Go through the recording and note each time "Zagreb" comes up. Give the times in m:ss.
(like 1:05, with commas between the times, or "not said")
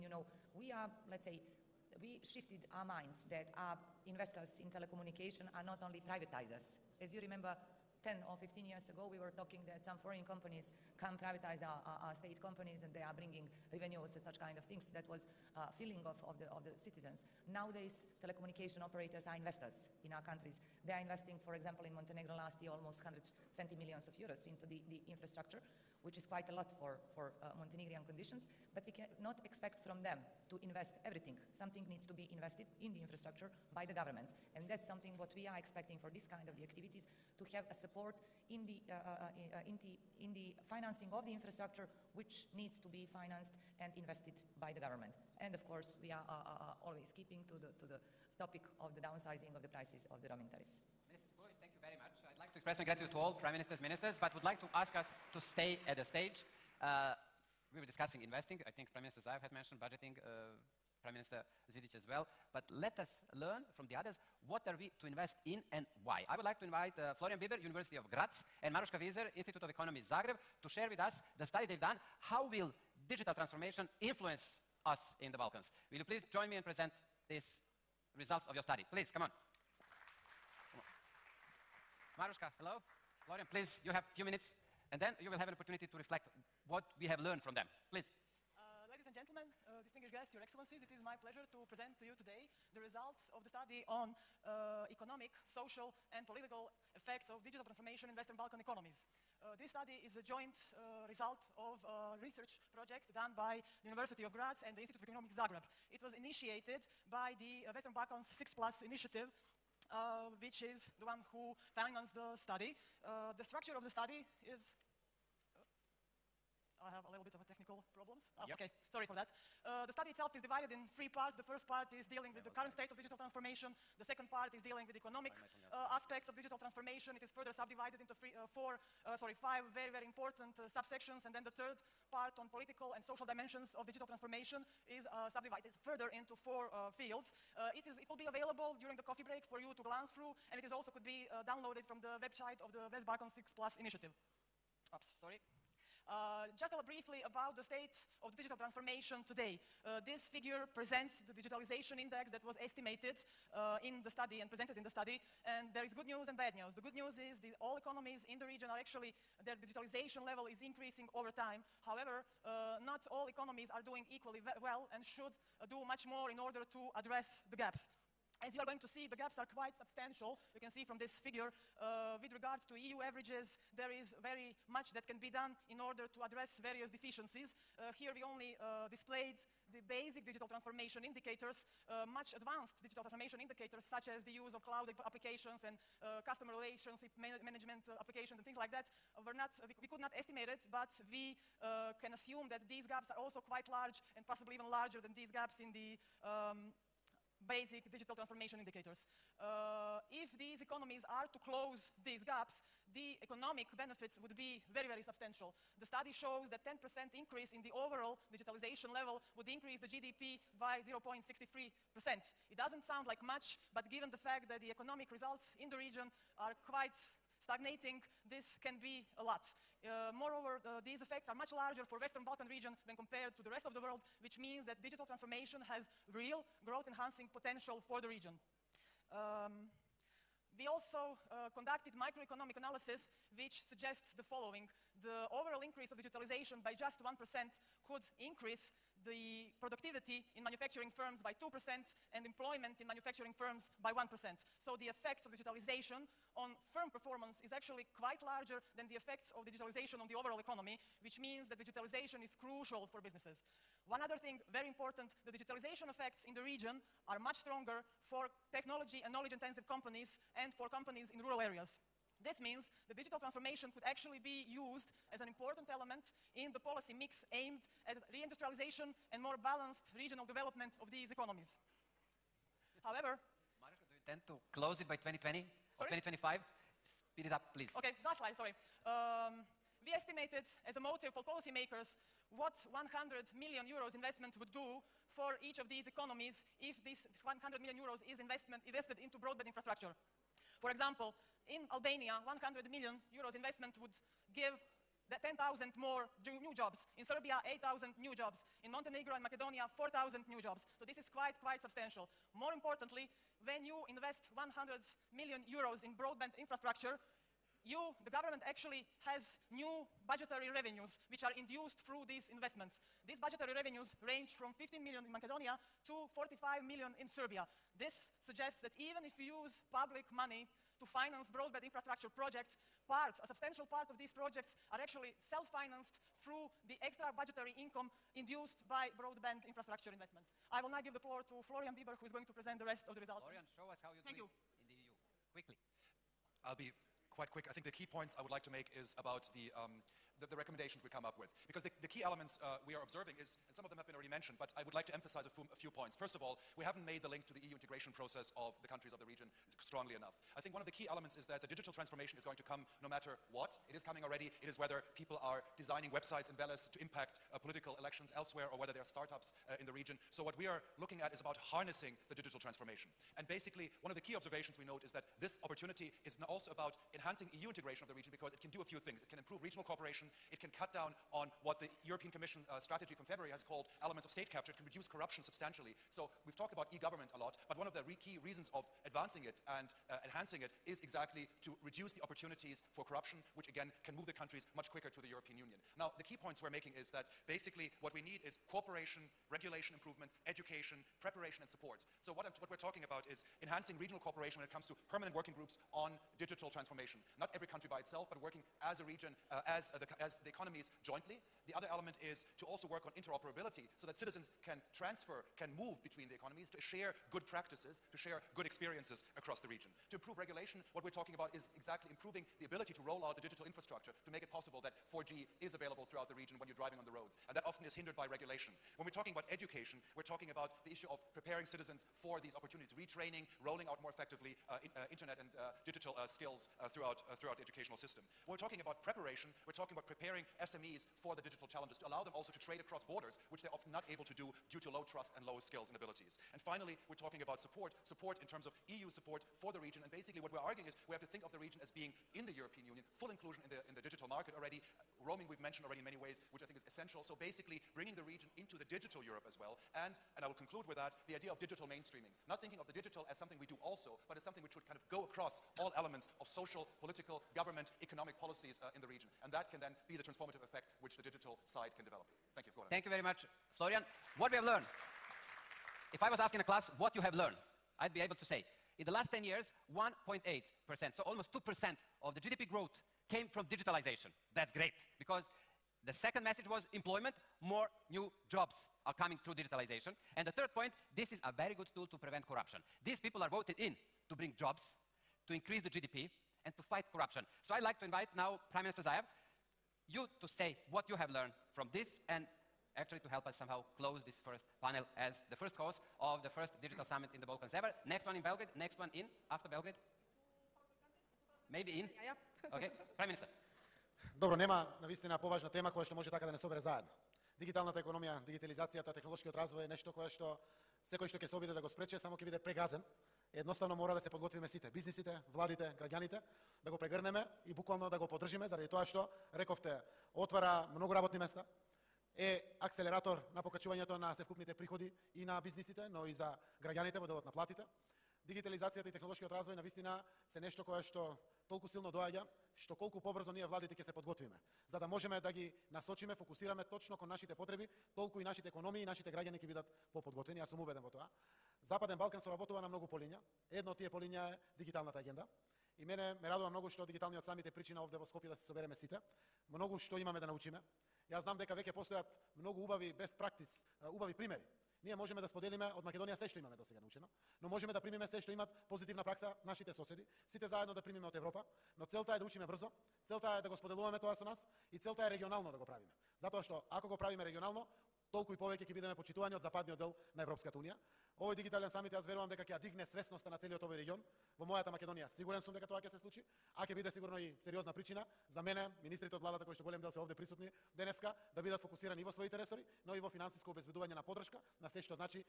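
1:10, 1:45.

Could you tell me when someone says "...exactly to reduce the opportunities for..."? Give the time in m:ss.
6:20.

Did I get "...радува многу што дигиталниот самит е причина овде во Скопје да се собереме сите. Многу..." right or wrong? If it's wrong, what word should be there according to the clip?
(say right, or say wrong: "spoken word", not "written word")
right.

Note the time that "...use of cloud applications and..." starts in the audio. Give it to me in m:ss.
3:04.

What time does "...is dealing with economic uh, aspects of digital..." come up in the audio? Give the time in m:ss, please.
2:04.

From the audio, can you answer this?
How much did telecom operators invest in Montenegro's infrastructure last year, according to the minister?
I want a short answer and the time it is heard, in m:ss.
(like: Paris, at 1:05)
120 million euros, at 0:22.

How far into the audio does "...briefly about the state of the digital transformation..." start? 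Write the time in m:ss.
2:26.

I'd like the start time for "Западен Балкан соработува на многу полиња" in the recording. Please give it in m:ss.
9:01.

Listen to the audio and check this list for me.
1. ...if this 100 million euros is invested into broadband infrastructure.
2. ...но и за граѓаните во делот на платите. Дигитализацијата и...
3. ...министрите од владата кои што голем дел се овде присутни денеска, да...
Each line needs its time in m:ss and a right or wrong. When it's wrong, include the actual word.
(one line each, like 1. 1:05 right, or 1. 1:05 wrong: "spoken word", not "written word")
1. 4:46 right
2. 8:45 right
3. 9:38 right.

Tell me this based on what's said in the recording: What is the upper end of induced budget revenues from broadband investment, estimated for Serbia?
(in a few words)
45 million.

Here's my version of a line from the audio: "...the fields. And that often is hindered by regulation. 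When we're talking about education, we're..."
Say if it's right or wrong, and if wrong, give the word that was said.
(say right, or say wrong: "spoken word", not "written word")
wrong: "roads", not "fields".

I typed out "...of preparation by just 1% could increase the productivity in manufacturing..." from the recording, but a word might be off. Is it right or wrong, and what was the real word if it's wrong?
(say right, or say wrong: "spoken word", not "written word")
wrong: "digitalization", not "preparation".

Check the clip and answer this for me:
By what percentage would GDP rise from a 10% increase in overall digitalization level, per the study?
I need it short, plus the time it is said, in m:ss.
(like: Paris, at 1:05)
0.63%, at 3:30.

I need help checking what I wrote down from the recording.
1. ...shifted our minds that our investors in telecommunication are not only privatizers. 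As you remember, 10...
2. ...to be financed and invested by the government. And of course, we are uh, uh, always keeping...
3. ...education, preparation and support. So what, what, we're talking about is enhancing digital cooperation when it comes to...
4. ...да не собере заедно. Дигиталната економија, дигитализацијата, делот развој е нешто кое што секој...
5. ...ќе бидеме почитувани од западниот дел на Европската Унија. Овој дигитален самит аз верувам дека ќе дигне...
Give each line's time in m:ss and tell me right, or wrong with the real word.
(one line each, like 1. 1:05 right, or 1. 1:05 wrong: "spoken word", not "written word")
1. 0:02 right
2. 0:42 right
3. 6:30 wrong: "regional", not "digital"
4. 8:26 wrong: "технолошкиот", not "делот"
5. 9:28 right.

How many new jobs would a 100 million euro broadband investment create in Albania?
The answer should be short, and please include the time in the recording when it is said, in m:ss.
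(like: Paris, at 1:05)
10,000, at 4:55.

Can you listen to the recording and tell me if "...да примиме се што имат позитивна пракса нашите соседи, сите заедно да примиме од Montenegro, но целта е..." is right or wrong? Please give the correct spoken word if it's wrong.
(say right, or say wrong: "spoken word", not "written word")
wrong: "Европа", not "Montenegro".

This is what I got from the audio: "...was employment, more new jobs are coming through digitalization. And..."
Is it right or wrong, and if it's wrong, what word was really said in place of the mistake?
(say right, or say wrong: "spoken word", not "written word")
right.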